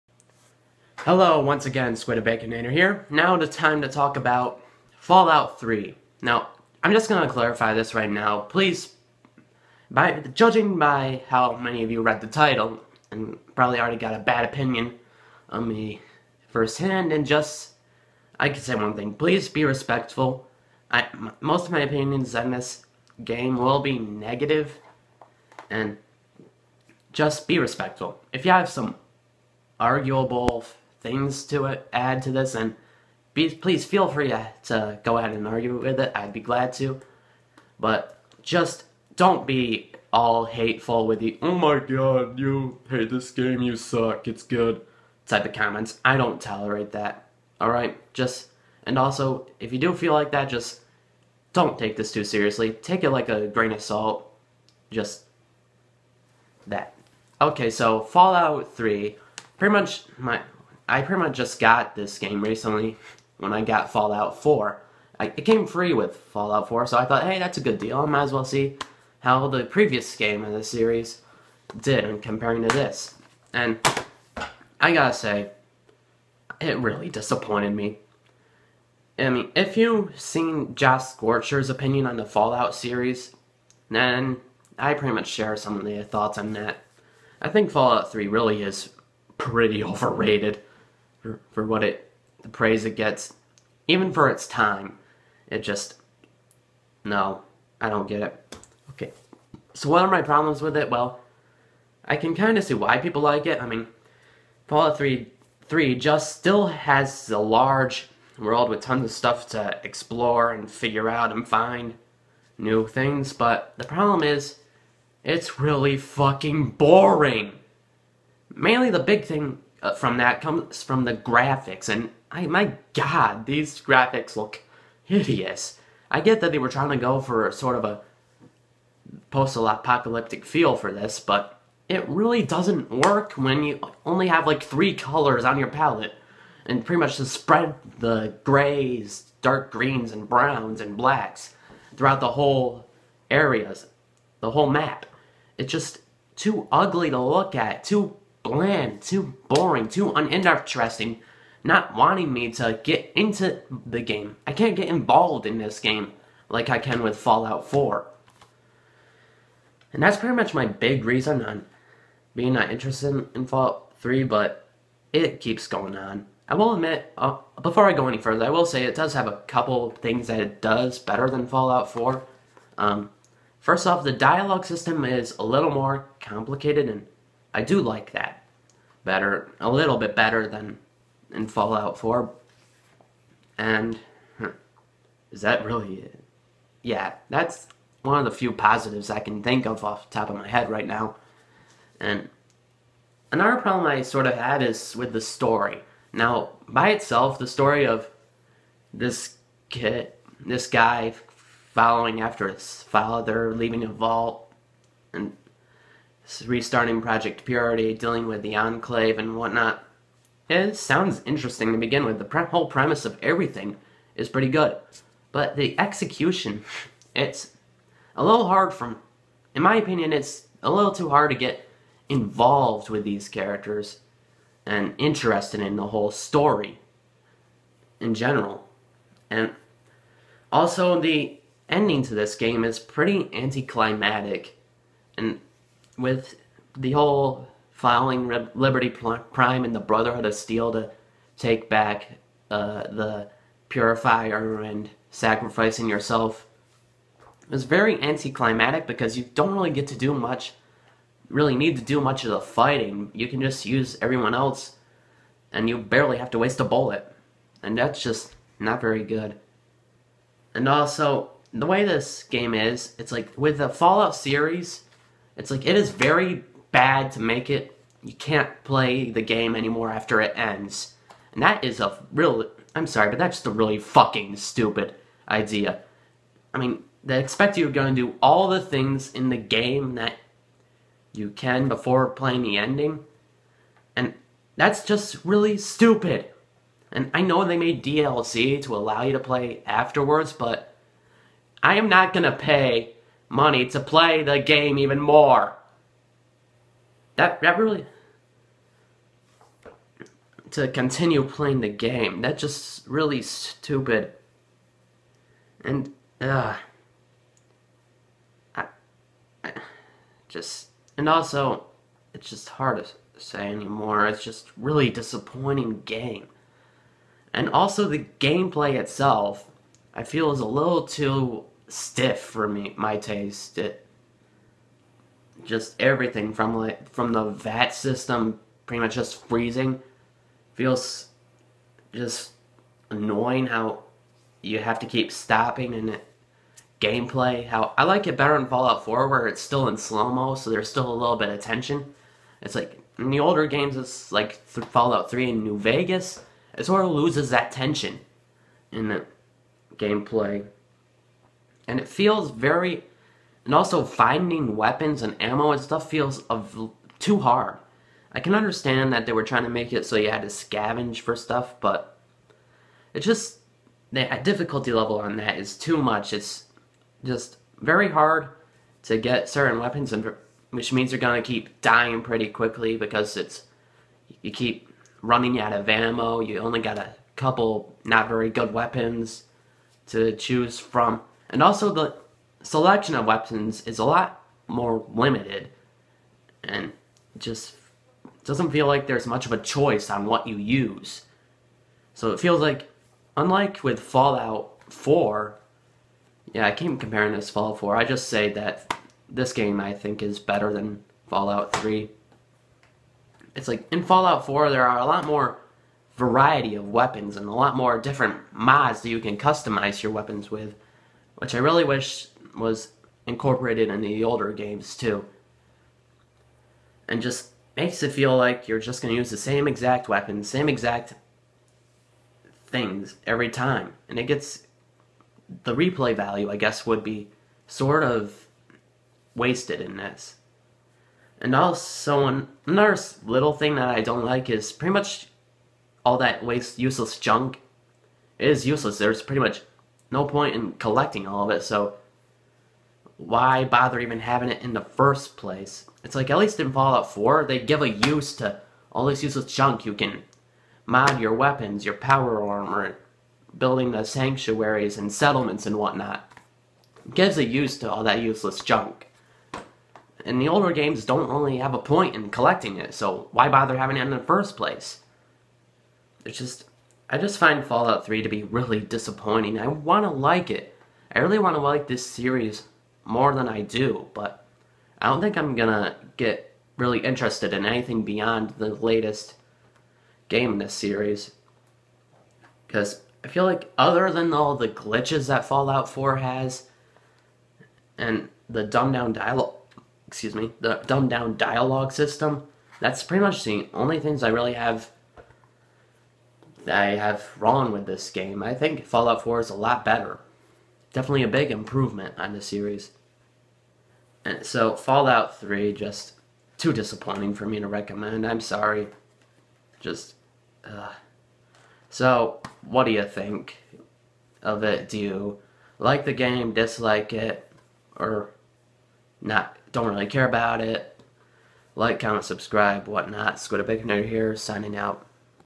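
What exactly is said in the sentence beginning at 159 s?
And that's pretty much my big reason on being not interested in Fallout 3, but it keeps going on.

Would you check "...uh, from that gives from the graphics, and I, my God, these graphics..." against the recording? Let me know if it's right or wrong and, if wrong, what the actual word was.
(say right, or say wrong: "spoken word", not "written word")
wrong: "comes", not "gives".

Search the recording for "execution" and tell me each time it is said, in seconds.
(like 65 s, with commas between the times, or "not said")
215 s.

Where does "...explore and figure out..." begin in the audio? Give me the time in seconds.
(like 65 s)
109 s.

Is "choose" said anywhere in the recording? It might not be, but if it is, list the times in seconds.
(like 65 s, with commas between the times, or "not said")
380 s.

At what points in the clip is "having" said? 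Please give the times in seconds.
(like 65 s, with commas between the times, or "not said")
443 s, 463 s.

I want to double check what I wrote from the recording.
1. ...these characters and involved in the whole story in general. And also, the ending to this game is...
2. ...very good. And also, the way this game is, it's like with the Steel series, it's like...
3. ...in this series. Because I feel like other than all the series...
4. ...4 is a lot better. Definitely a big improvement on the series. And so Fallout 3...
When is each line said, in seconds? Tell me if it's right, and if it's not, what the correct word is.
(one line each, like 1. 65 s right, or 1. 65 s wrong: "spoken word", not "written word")
1. 223 s wrong: "interested", not "involved"
2. 258 s wrong: "Fallout", not "Steel"
3. 480 s wrong: "glitches", not "series"
4. 499 s right.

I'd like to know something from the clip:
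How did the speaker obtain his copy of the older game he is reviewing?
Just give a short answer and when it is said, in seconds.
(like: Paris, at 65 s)
Came free with Fallout 4, at 65 s.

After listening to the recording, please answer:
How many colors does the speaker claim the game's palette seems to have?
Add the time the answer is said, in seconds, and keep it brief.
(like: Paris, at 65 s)
3, at 134 s.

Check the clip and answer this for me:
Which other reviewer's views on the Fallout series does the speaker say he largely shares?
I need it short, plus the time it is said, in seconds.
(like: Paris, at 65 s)
Josh Scorcher, at 80 s.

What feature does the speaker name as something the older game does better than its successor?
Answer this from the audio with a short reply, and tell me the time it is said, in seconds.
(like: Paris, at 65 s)
The dialogue system, at 174 s.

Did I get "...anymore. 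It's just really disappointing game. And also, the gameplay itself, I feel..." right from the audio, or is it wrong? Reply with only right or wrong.
right.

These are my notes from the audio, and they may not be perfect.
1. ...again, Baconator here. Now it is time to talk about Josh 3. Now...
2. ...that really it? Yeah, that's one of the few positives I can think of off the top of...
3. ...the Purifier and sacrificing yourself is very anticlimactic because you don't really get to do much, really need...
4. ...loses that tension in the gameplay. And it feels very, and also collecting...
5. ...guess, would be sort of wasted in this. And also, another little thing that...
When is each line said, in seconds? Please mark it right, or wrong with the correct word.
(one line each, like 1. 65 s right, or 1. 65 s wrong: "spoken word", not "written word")
1. 1 s wrong: "Fallout", not "Josh"
2. 185 s right
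3. 242 s right
4. 346 s wrong: "finding", not "collecting"
5. 426 s right.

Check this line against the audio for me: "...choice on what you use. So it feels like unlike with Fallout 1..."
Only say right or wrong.
wrong.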